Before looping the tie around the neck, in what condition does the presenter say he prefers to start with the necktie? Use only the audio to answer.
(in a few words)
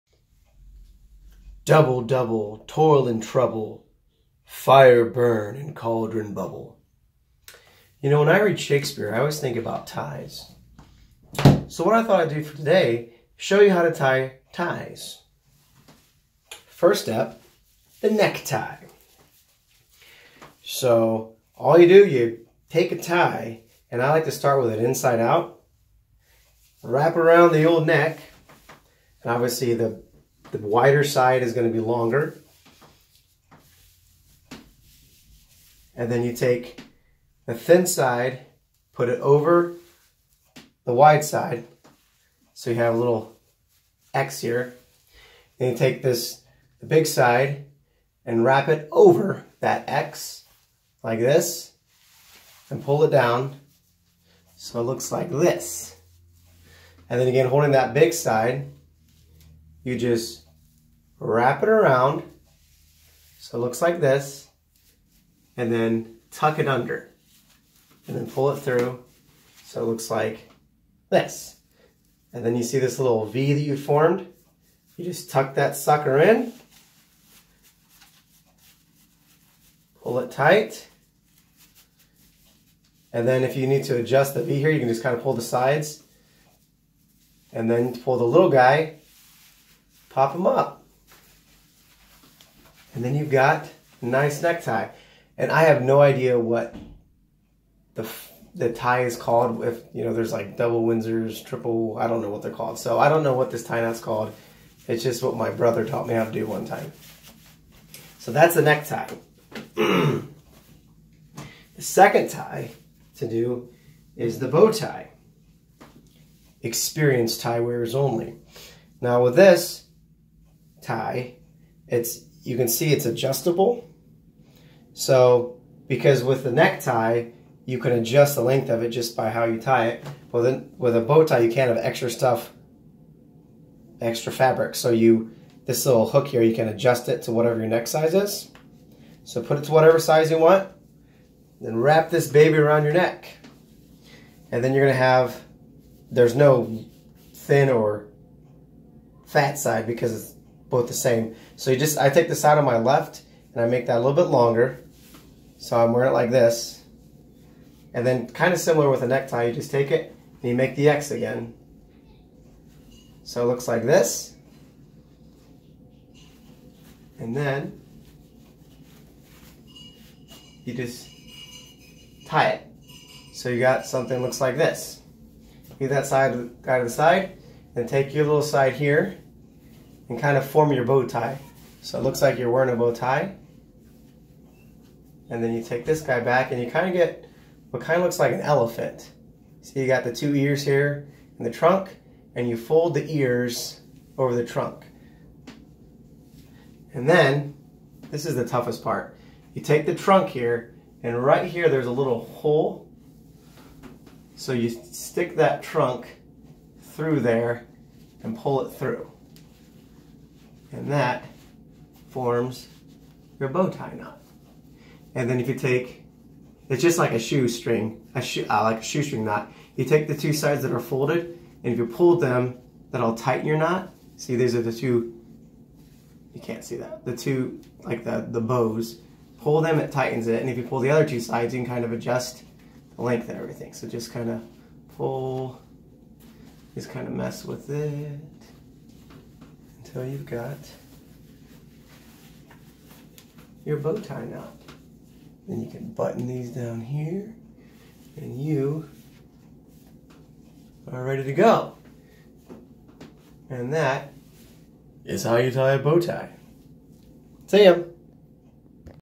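Inside out.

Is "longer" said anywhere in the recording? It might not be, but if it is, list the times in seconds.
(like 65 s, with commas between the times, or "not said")
31 s, 154 s.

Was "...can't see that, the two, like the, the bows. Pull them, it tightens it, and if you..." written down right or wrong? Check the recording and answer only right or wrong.
right.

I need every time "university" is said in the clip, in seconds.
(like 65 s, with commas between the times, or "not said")
not said.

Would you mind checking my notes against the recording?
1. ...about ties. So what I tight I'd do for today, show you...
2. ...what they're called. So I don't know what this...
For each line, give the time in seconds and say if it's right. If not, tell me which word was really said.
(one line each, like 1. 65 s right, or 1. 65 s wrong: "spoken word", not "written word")
1. 9 s wrong: "thought", not "tight"
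2. 102 s right.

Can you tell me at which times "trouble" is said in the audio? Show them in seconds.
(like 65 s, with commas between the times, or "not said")
3 s.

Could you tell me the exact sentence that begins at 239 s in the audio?
So you've got your bow tie knot.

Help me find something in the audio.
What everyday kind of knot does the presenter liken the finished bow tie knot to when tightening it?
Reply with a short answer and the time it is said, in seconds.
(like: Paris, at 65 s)
Shoestring knot, at 218 s.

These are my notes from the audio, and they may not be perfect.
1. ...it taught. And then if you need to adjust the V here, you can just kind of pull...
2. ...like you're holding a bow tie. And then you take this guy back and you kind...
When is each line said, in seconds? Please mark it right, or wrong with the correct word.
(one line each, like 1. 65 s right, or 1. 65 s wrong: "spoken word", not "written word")
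1. 80 s wrong: "tight", not "taught"
2. 182 s wrong: "wearing", not "holding".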